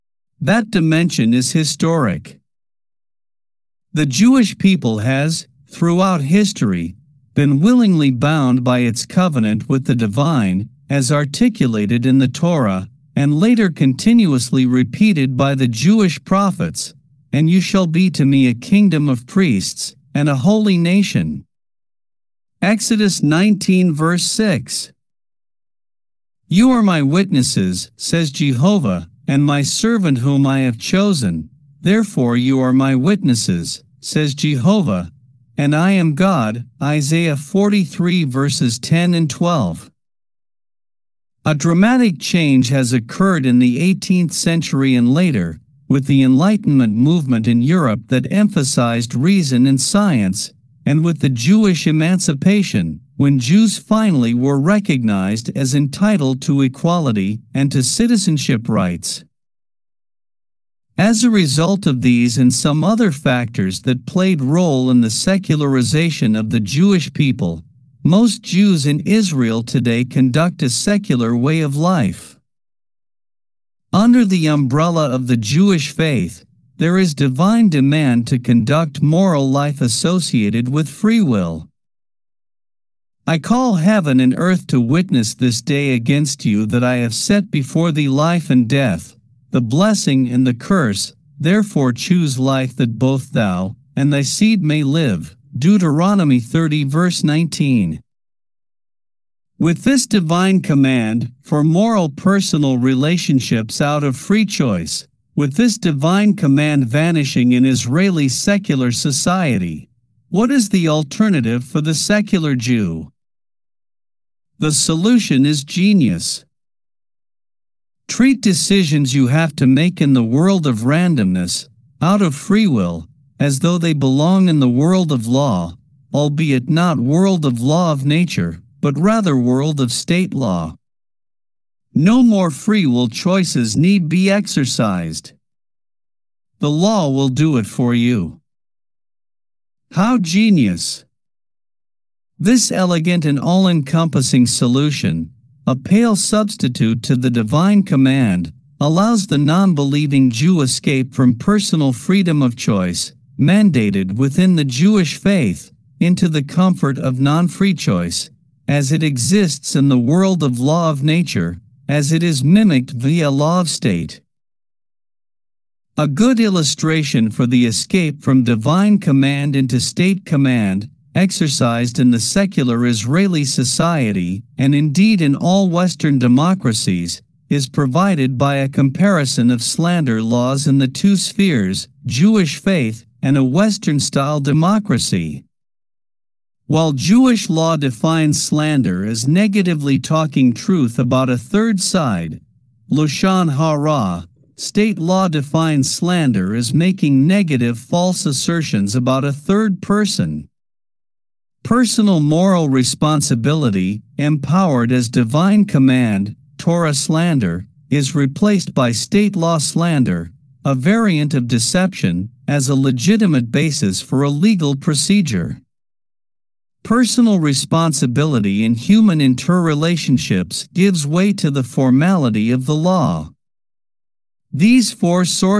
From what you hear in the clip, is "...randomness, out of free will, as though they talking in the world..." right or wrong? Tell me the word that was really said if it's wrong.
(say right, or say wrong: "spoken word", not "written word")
wrong: "belong", not "talking".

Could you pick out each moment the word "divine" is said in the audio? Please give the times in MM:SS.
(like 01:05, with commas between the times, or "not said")
00:09, 01:17, 01:40, 01:45, 02:27, 02:48, 03:25.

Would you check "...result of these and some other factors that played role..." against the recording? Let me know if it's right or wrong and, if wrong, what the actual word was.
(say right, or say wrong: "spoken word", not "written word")
right.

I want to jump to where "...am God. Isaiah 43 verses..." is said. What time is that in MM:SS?
00:35.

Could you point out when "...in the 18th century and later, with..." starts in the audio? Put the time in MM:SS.
00:43.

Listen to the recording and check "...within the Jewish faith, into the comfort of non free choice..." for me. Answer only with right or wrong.
right.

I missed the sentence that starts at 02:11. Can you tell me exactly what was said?
No more free will choices need be exercised.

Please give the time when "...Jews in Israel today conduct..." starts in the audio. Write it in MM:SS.
01:08.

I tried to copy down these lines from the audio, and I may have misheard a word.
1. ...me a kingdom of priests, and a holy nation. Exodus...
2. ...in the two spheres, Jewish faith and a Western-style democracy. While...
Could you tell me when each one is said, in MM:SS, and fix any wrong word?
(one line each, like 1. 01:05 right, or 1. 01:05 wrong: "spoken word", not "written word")
1. 00:18 right
2. 03:00 right.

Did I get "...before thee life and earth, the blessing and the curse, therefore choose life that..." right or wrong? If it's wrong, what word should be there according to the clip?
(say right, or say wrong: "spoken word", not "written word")
wrong: "death", not "earth".